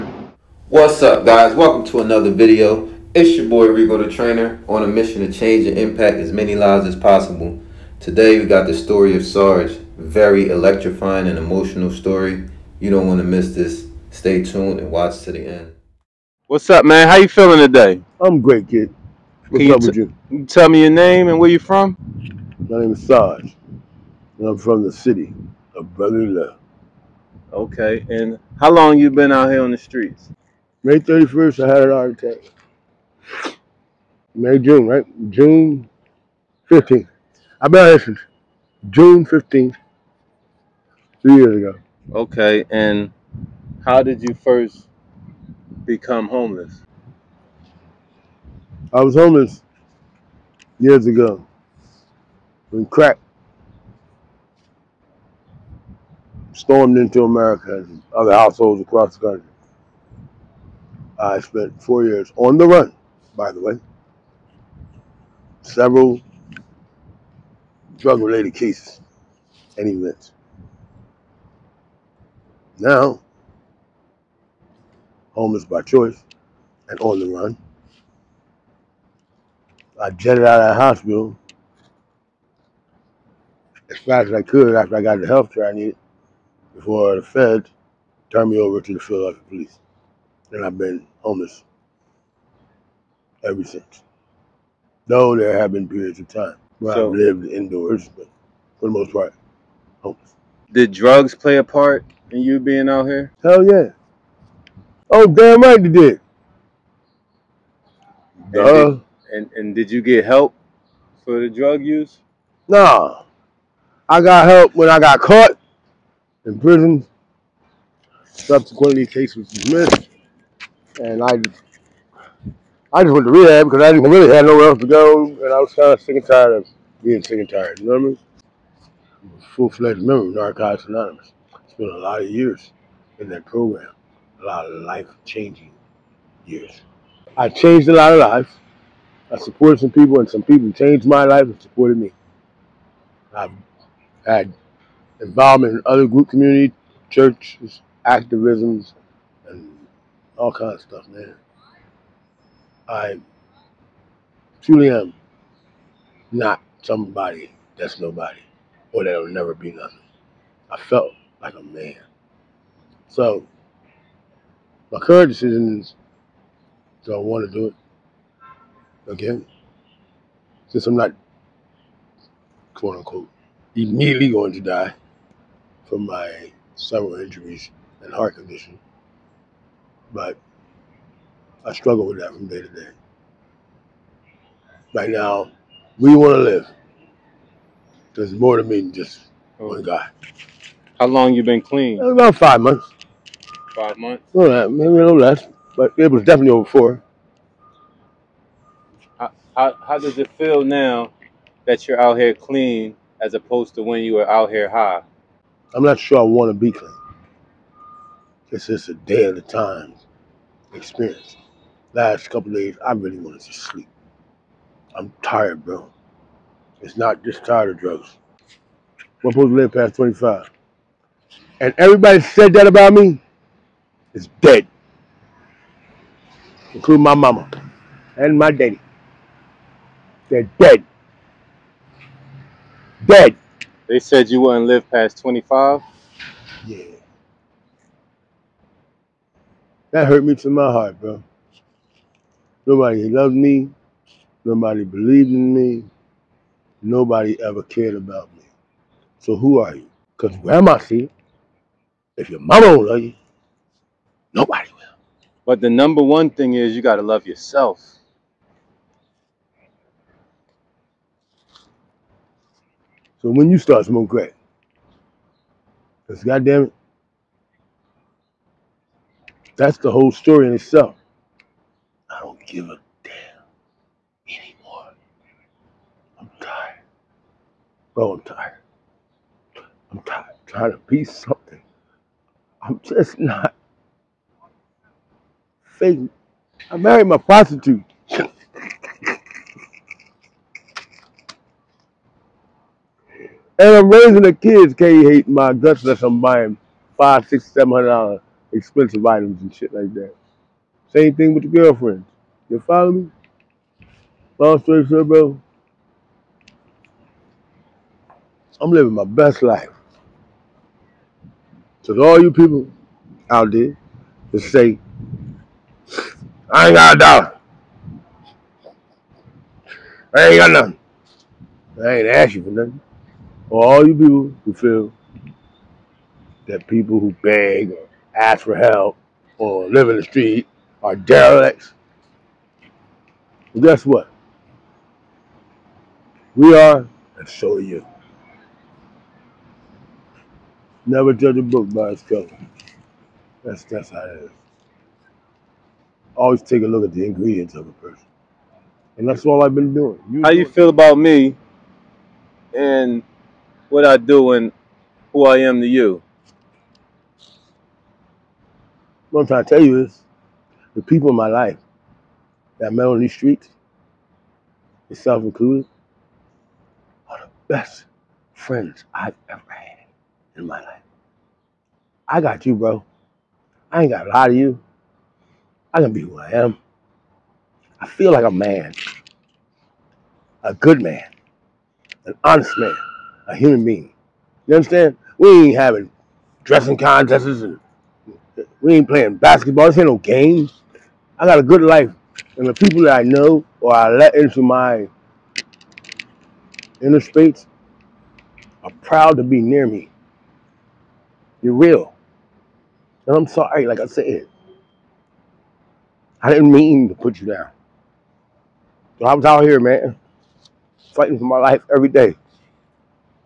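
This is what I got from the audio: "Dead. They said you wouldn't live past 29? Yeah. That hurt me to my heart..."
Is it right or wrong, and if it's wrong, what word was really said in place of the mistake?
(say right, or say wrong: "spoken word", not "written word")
wrong: "25", not "29".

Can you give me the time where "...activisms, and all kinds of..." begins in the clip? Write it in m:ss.
2:28.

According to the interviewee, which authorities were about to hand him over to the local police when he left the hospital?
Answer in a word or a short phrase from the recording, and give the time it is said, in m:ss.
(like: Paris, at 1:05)
The feds, at 1:27.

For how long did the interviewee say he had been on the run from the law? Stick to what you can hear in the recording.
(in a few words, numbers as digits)
4 years.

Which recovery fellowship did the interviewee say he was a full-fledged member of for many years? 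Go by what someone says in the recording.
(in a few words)
Narcotics Anonymous.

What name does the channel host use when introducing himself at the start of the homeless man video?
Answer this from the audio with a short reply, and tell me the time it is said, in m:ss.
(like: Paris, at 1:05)
Reko the Trainer, at 0:03.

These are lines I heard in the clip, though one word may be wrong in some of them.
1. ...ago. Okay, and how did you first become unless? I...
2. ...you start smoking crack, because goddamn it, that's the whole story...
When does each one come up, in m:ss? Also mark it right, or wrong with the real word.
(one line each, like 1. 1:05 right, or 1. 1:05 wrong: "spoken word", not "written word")
1. 0:41 wrong: "homeless", not "unless"
2. 4:23 right.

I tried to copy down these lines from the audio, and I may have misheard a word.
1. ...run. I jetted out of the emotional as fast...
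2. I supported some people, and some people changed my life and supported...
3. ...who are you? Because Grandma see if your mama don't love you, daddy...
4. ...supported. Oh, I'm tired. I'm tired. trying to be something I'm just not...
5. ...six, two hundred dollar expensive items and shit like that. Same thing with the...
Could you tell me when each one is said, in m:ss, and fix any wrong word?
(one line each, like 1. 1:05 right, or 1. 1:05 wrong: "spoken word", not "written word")
1. 1:17 wrong: "hospital", not "emotional"
2. 2:19 right
3. 4:09 wrong: "nobody", not "daddy"
4. 4:36 wrong: "tired", not "supported"
5. 4:57 wrong: "seven", not "two".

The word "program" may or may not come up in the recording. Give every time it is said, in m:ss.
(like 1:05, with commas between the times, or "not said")
2:13.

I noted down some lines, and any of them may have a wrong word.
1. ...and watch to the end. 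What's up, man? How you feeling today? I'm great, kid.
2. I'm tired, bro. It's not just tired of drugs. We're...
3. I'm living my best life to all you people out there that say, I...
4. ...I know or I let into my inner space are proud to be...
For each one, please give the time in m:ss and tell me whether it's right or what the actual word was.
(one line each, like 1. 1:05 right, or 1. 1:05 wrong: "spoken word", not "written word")
1. 0:14 right
2. 3:34 right
3. 5:08 right
4. 6:32 right.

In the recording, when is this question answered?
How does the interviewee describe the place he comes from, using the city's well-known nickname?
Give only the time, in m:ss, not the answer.
0:24.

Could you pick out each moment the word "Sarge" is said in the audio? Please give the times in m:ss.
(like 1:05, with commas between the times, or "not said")
0:09, 0:23.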